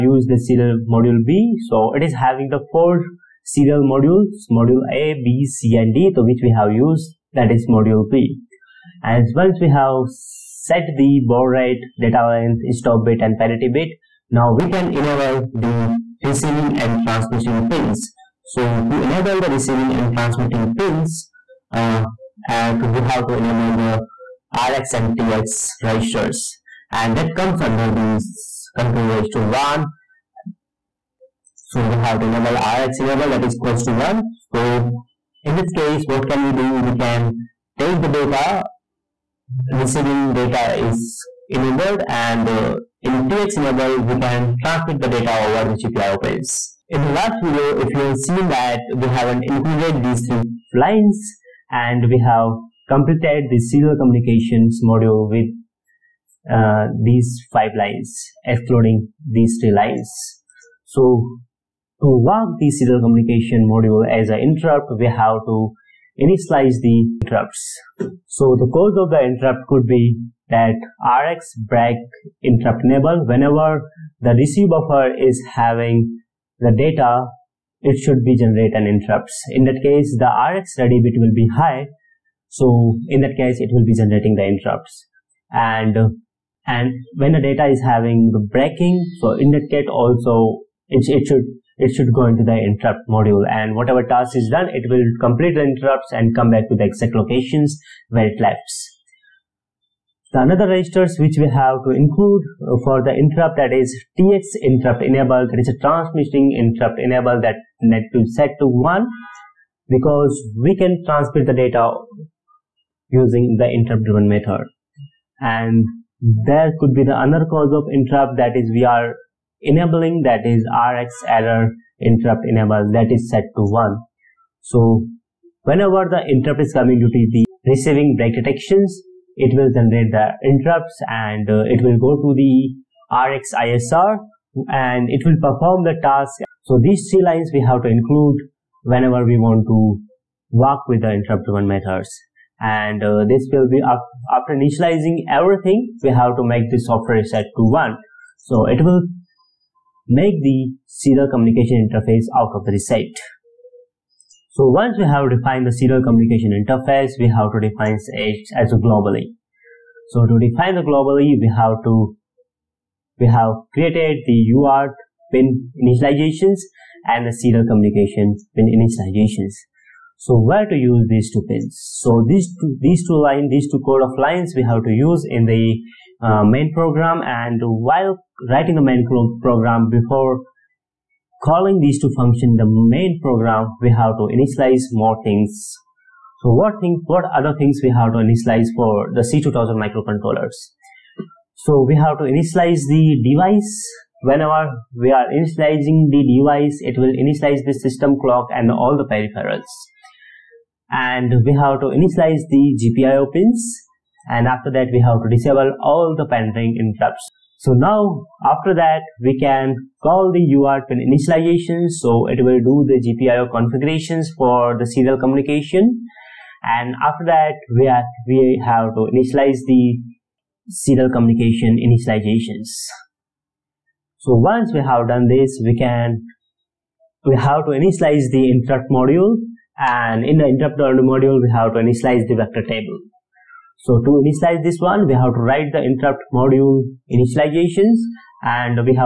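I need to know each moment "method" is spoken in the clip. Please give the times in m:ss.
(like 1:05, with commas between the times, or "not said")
1:54, 2:21.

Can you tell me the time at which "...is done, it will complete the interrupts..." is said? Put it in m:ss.
1:34.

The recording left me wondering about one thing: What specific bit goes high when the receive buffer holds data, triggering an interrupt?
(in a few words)
Rx ready bit.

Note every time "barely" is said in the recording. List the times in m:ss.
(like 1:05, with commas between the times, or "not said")
not said.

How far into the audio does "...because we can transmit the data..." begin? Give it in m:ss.
1:49.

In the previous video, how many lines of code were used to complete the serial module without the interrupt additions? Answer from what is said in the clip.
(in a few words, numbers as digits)
5.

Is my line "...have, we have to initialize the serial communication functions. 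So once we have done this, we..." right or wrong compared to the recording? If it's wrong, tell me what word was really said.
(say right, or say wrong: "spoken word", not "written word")
wrong: "initializations", not "functions".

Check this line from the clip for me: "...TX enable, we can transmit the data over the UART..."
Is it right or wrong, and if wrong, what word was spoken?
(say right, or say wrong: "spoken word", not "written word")
wrong: "GPIO", not "UART".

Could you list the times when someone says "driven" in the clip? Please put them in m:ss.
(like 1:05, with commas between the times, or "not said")
1:54, 2:21.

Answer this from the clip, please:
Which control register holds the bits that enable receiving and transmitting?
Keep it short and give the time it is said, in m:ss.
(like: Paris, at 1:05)
Control register 1, at 0:28.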